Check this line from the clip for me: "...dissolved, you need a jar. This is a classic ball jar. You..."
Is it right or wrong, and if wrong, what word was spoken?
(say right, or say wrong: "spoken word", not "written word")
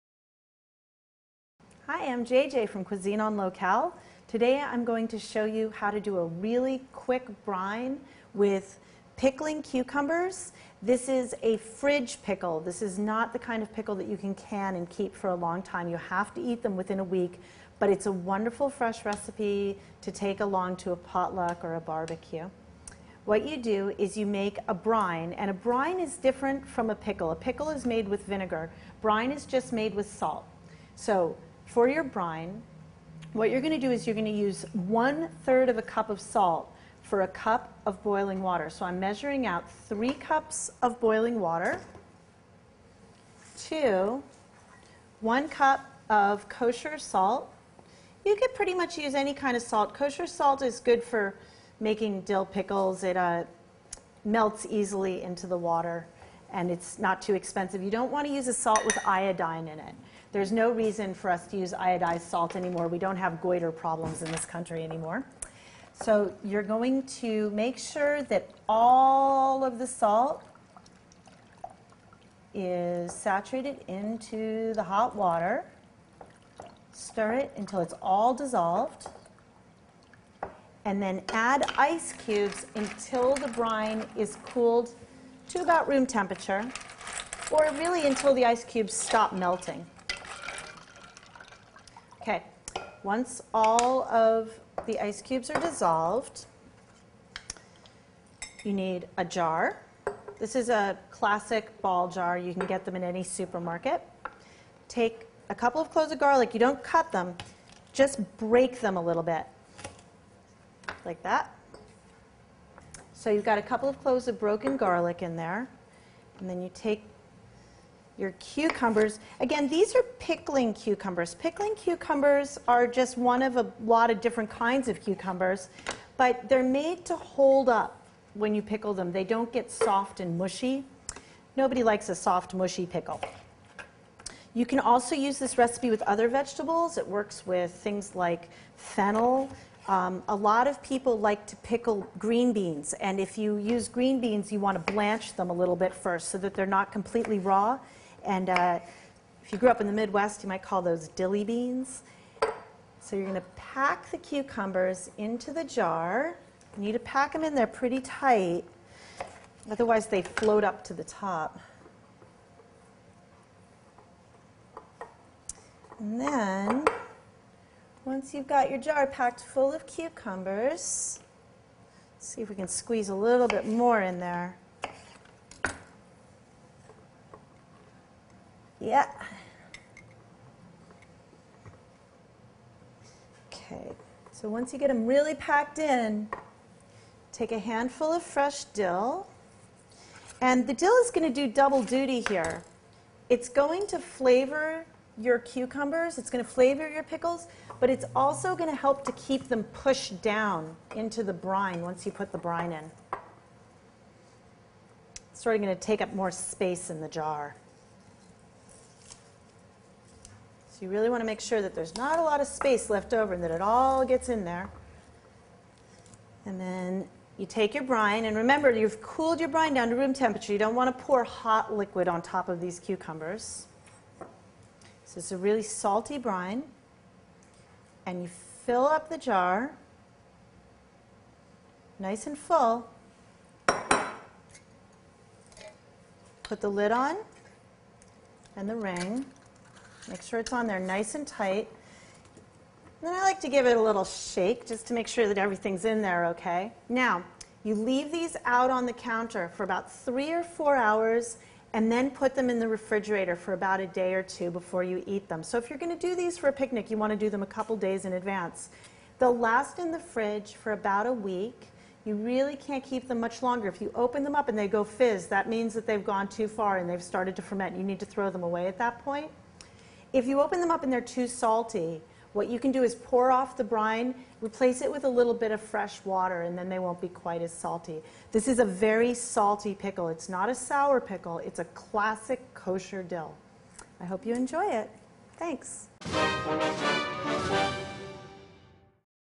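right.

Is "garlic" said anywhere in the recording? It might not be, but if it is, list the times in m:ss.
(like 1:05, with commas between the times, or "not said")
1:46, 1:54.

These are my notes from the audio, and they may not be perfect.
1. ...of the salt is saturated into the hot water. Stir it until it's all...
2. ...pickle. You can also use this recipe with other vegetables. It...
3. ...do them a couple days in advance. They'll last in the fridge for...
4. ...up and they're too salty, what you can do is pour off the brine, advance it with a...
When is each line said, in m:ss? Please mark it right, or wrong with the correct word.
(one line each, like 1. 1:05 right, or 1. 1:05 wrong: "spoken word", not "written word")
1. 1:09 right
2. 2:12 right
3. 4:17 right
4. 4:30 wrong: "replace", not "advance".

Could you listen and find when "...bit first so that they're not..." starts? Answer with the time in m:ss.
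2:25.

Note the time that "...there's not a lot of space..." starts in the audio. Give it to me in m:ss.
3:31.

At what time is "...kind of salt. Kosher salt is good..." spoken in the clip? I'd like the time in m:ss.
0:49.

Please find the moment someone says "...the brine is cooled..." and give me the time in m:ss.
1:23.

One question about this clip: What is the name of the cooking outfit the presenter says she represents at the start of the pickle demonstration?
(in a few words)
Cuisine en Locale.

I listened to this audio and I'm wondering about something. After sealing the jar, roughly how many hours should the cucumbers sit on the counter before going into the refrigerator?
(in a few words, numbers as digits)
3 or 4 hours.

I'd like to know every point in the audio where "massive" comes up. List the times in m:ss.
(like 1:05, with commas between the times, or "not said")
not said.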